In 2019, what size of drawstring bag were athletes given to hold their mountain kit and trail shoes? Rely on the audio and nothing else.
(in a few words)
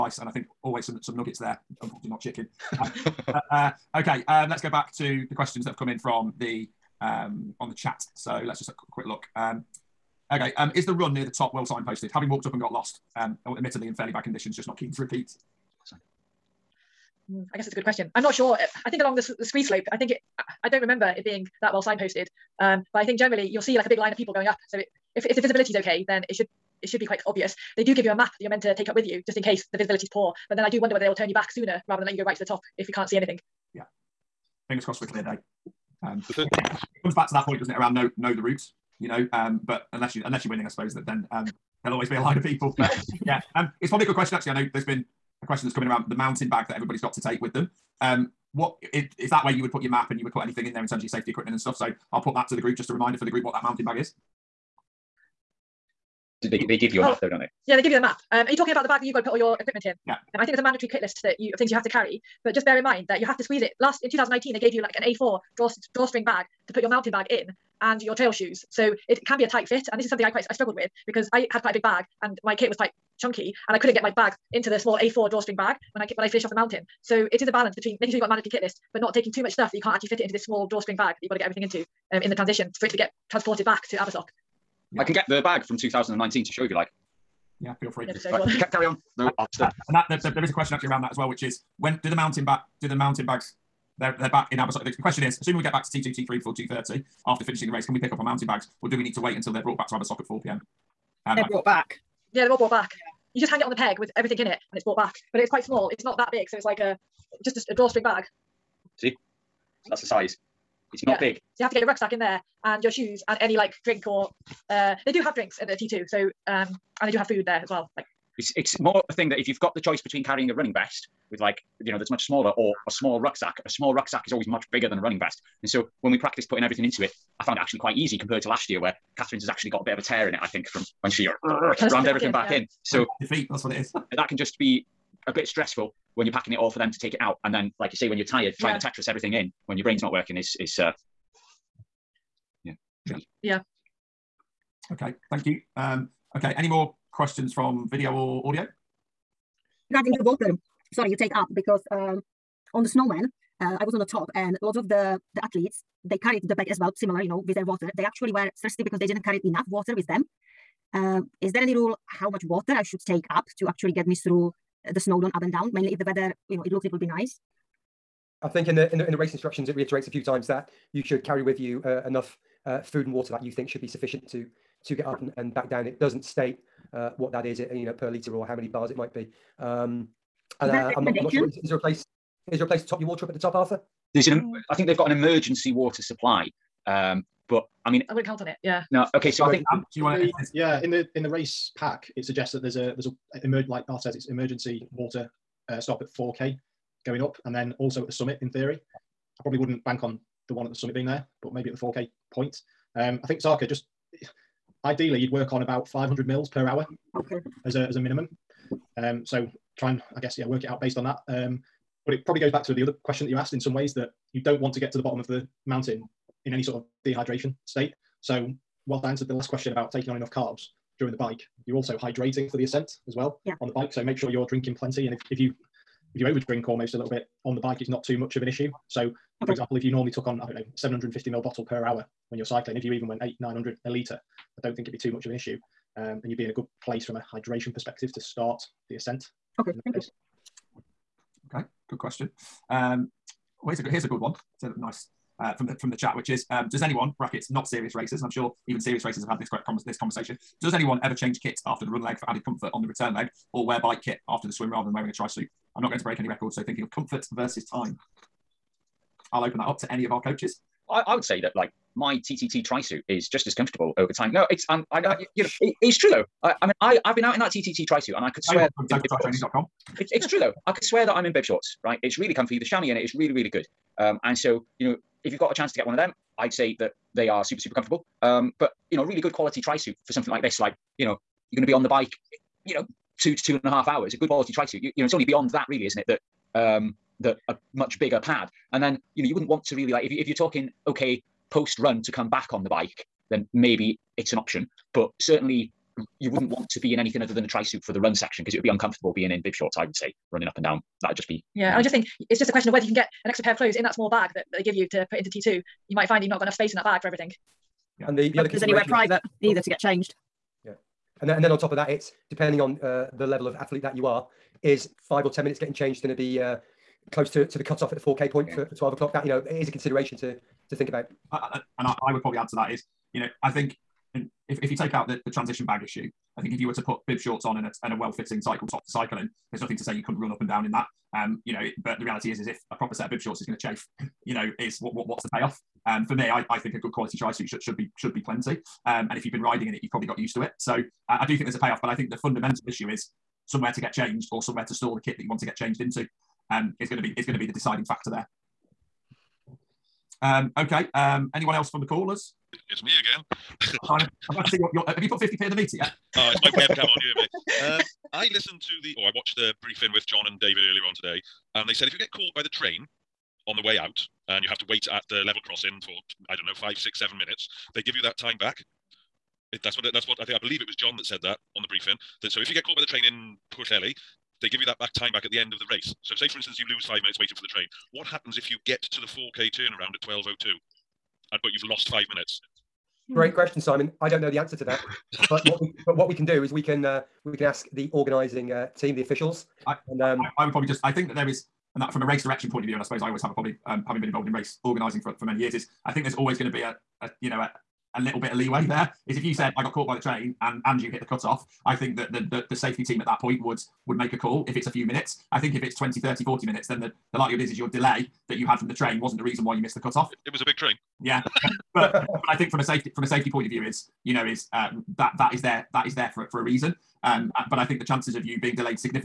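A4.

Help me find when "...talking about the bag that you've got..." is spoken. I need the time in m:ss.
0:58.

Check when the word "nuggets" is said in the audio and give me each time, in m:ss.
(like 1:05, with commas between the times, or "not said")
0:01.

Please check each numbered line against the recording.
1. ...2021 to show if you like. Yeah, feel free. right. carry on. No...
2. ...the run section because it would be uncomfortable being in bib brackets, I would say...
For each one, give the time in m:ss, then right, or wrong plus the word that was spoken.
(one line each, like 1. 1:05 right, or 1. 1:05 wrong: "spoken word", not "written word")
1. 1:25 wrong: "2019", not "2021"
2. 4:57 wrong: "shorts", not "brackets".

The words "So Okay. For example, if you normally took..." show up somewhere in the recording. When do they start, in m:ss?
3:48.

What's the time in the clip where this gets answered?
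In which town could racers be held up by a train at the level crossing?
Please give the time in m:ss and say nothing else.
6:13.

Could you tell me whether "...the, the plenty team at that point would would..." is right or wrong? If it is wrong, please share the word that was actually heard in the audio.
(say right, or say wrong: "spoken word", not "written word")
wrong: "safety", not "plenty".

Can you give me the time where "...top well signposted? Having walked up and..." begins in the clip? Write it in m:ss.
0:11.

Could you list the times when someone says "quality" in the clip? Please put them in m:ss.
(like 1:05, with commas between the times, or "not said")
4:39, 4:44, 5:36.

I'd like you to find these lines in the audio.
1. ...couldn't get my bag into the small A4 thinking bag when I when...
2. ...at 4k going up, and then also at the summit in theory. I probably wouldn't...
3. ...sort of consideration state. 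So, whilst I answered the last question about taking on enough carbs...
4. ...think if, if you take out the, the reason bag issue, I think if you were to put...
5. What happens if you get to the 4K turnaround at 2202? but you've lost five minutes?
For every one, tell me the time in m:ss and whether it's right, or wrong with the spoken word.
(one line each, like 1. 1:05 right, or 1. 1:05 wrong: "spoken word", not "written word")
1. 1:13 wrong: "drawstring", not "thinking"
2. 3:16 right
3. 3:36 wrong: "dehydration", not "consideration"
4. 5:23 wrong: "transition", not "reason"
5. 6:17 wrong: "1202", not "2202".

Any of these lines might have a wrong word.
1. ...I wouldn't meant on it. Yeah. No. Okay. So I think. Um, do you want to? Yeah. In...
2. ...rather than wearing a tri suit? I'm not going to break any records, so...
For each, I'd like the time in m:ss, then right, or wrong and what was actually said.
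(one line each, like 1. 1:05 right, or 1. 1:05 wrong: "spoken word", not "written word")
1. 3:08 wrong: "count", not "meant"
2. 4:14 right.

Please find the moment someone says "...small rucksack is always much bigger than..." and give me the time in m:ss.
2:03.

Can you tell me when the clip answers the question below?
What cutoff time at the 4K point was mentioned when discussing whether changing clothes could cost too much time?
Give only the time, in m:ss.
5:18.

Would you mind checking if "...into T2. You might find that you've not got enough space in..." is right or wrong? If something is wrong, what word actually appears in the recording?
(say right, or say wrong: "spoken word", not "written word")
right.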